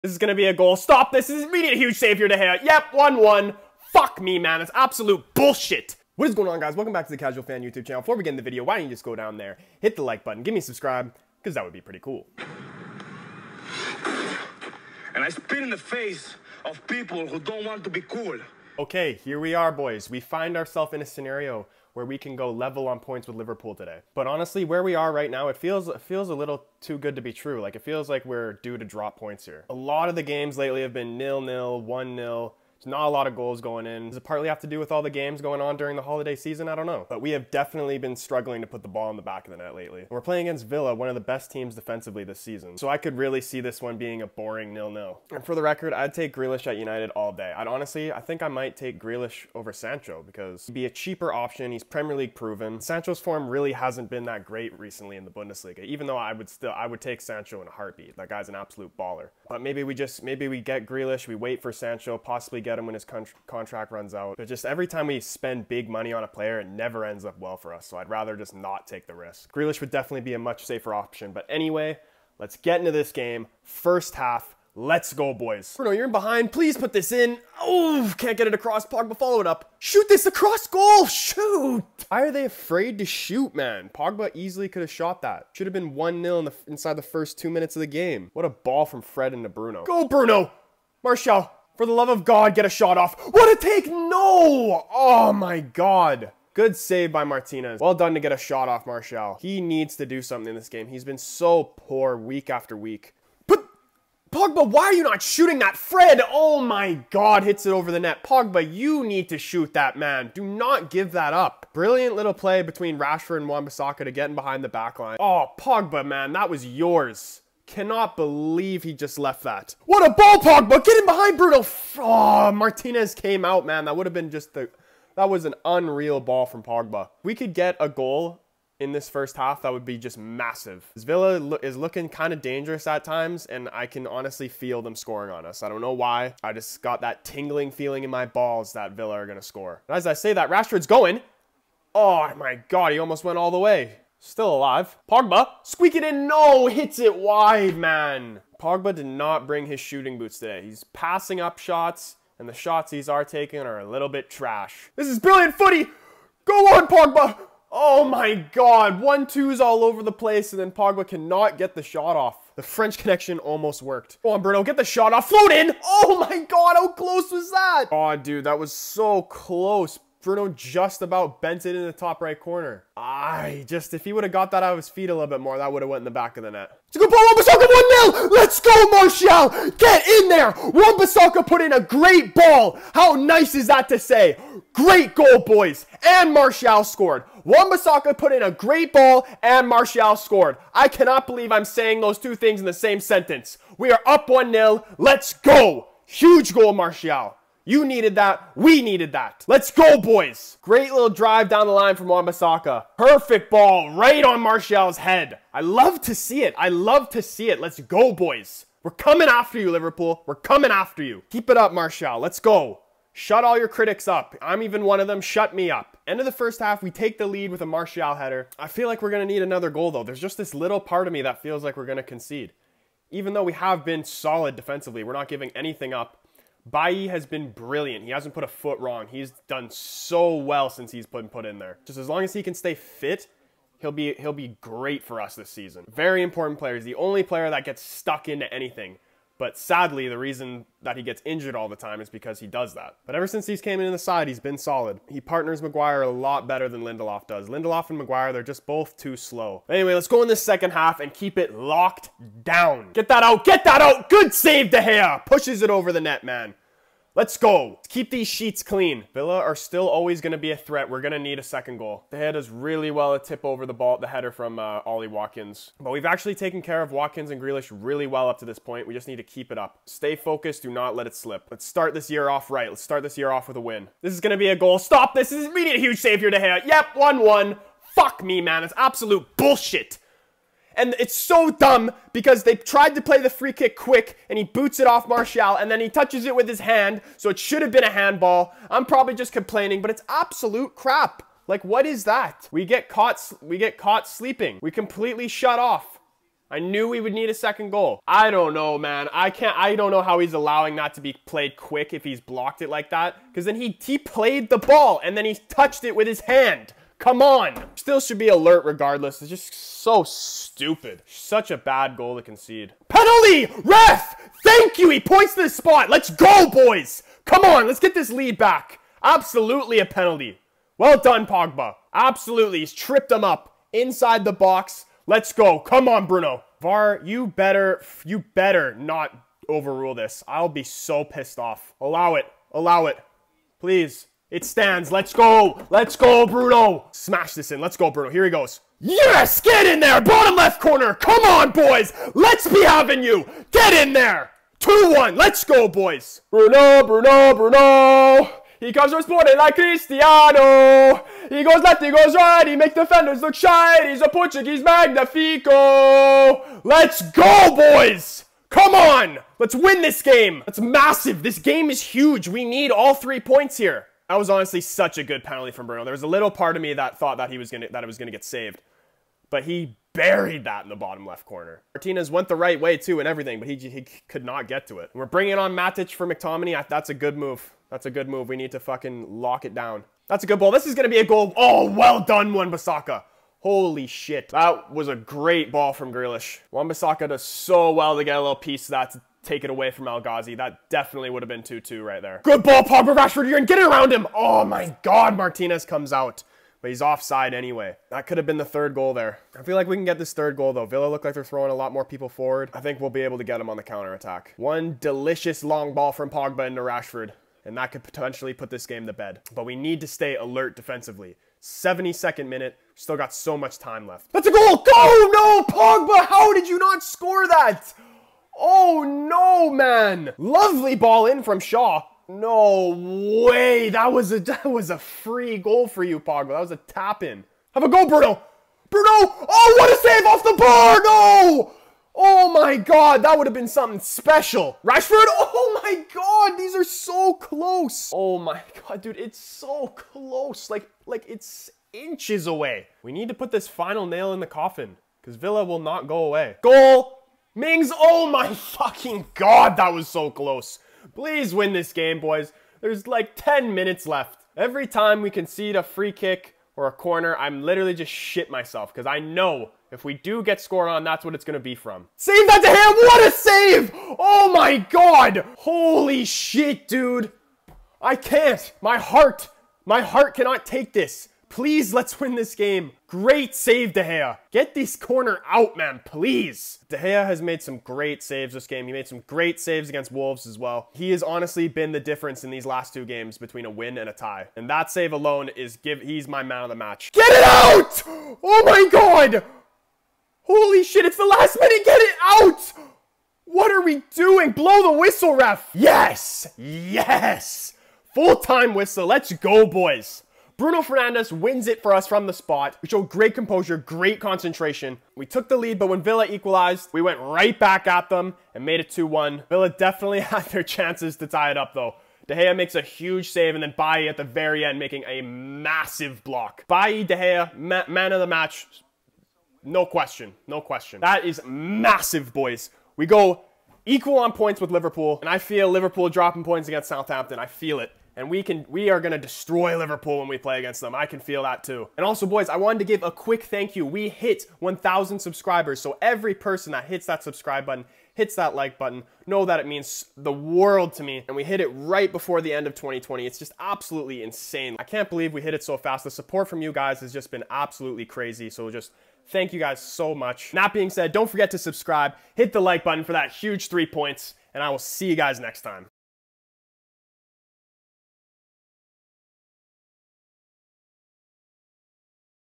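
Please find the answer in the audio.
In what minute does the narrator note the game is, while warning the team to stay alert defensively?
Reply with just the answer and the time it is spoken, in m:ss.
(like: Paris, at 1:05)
72nd, at 6:51.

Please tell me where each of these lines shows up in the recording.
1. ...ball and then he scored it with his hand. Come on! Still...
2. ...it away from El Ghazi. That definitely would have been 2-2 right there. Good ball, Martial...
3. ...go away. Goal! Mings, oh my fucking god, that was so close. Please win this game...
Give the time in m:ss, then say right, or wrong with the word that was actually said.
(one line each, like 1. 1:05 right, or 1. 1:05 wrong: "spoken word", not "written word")
1. 5:04 wrong: "touched", not "scored"
2. 6:29 wrong: "Pogba", not "Martial"
3. 7:25 right.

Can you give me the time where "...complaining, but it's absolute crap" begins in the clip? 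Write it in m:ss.
4:49.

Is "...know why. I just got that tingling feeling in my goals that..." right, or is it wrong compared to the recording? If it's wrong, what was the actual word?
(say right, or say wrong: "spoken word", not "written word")
wrong: "balls", not "goals".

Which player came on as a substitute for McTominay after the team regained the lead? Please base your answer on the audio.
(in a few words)
Matic.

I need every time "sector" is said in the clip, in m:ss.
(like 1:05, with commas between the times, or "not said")
not said.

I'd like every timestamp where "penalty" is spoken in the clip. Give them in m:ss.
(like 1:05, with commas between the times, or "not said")
5:12, 5:19, 6:05.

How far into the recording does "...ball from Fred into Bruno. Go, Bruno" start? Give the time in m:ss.
1:28.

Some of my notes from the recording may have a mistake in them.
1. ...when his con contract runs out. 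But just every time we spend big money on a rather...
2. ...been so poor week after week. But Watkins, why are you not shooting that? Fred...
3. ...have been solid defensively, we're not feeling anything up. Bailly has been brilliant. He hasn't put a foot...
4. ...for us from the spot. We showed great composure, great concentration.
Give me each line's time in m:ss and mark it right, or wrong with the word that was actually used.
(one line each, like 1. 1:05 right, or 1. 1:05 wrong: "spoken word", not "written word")
1. 1:02 wrong: "player", not "rather"
2. 1:41 wrong: "Pogba", not "Watkins"
3. 3:43 wrong: "giving", not "feeling"
4. 8:21 right.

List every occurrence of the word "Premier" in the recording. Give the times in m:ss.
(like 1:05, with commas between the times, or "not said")
0:51.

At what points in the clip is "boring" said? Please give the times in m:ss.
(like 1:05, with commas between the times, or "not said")
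0:44.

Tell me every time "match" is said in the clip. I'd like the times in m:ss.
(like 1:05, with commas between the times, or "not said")
8:06, 8:38.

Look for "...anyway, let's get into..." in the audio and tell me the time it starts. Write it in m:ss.
1:11.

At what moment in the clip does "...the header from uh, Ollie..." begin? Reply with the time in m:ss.
4:23.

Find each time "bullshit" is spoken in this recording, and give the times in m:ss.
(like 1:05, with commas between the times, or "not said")
0:05, 4:39.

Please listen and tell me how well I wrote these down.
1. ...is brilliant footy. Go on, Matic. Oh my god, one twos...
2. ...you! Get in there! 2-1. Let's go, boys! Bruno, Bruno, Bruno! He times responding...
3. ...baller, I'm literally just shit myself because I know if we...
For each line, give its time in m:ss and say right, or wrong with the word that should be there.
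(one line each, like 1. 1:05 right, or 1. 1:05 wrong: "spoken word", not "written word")
1. 2:35 wrong: "Pogba", not "Matic"
2. 5:43 wrong: "comes", not "times"
3. 7:36 wrong: "corner", not "baller".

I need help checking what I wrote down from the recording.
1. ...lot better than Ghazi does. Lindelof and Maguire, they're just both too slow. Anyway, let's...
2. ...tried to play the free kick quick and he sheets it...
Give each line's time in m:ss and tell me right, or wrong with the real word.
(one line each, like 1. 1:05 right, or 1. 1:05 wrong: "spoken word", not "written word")
1. 4:06 wrong: "Lindelof", not "Ghazi"
2. 4:42 wrong: "boots", not "sheets".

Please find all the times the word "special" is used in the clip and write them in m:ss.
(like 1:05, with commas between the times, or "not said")
7:13.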